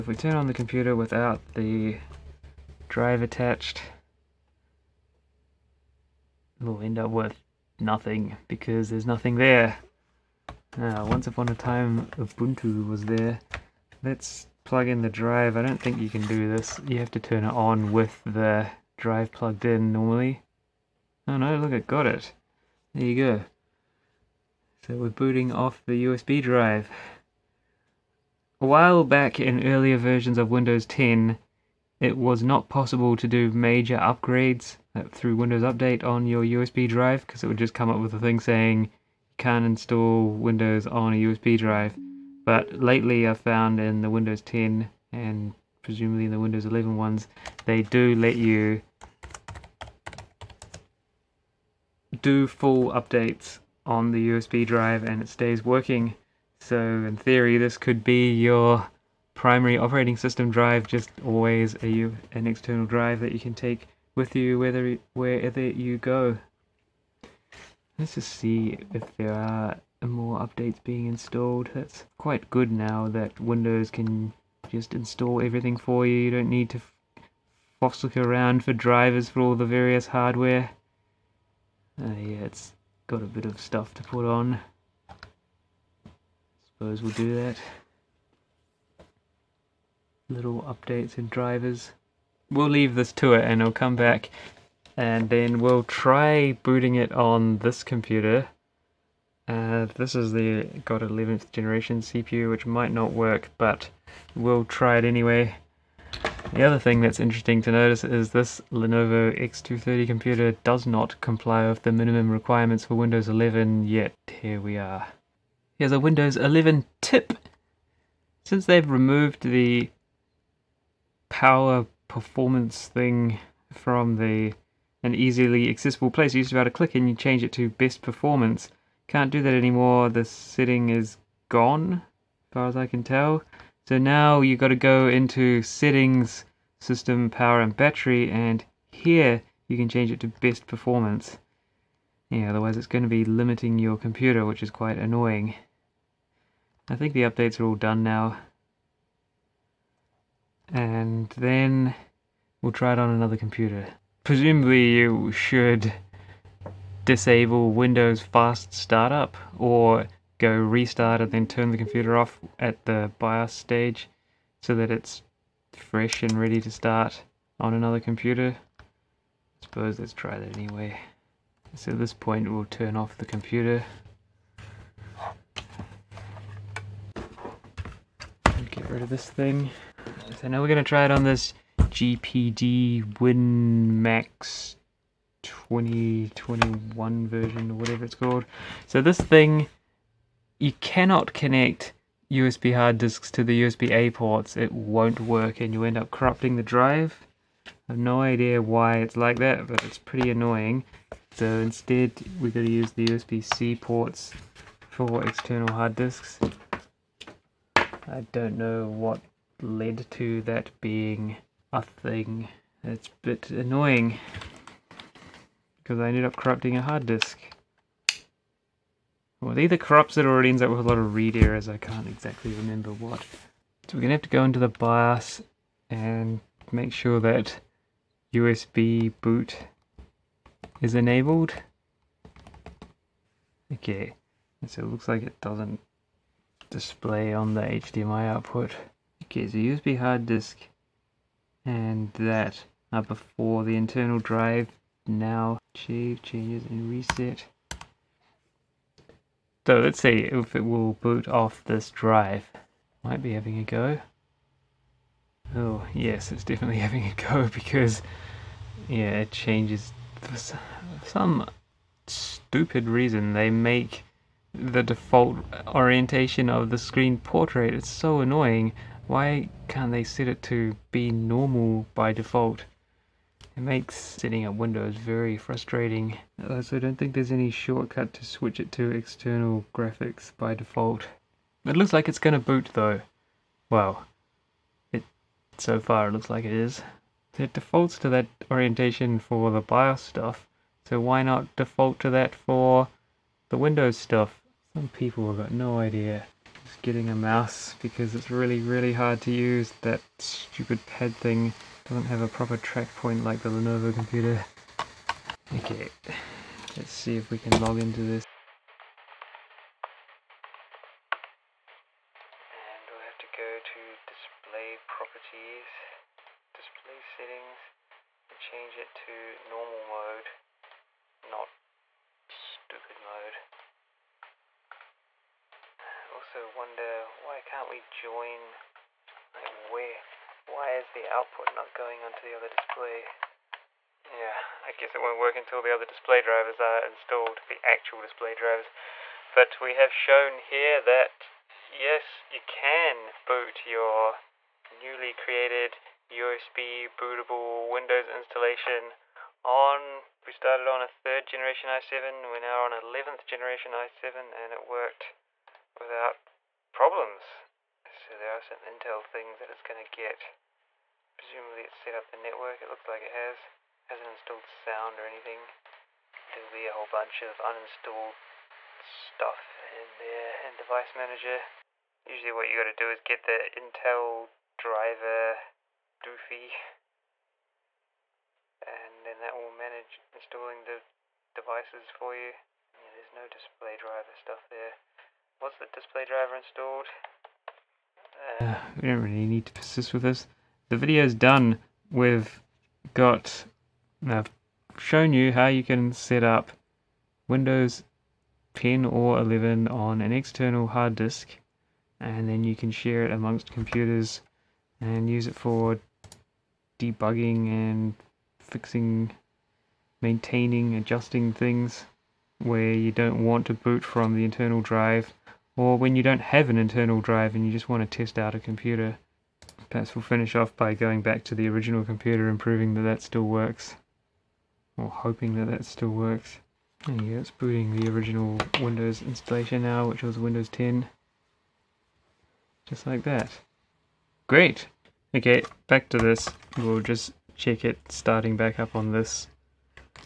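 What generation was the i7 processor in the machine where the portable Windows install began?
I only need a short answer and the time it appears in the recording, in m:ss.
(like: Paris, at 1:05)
3rd generation, at 5:50.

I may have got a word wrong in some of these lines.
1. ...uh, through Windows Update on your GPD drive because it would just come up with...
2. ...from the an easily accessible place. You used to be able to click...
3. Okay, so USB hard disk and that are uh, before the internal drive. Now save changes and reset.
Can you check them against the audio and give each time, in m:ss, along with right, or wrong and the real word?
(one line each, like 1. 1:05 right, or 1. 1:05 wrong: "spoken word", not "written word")
1. 0:34 wrong: "USB", not "GPD"
2. 2:03 right
3. 3:59 right.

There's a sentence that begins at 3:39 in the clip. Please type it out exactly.
Well, it either corrupts it or it ends up with a lot of read errors.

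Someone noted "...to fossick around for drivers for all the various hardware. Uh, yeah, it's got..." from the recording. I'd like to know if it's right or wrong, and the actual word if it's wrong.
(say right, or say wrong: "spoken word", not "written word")
right.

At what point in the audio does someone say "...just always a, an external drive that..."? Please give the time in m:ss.
1:00.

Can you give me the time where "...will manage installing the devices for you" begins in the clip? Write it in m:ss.
6:19.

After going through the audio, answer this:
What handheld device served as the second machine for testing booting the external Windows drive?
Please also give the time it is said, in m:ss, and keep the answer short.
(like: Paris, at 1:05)
GPD WinMax 2021, at 3:01.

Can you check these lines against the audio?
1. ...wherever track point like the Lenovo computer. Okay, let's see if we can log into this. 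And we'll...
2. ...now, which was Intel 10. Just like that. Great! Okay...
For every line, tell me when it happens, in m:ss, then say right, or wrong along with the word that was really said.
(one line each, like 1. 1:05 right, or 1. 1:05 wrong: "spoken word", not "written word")
1. 5:02 wrong: "proper", not "wherever"
2. 7:09 wrong: "Windows", not "Intel".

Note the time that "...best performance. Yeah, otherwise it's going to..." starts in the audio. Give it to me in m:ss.
2:20.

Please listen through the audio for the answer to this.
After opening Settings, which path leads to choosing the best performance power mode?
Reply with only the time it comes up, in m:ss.
2:16.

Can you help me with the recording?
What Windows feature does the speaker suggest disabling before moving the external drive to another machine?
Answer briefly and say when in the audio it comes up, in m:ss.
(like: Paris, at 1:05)
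Fast startup, at 2:38.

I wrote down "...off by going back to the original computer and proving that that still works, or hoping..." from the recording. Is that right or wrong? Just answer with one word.
right.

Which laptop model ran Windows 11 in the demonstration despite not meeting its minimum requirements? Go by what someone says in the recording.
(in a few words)
Lenovo X230.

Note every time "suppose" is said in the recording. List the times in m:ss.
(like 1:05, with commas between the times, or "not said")
1:26, 2:49.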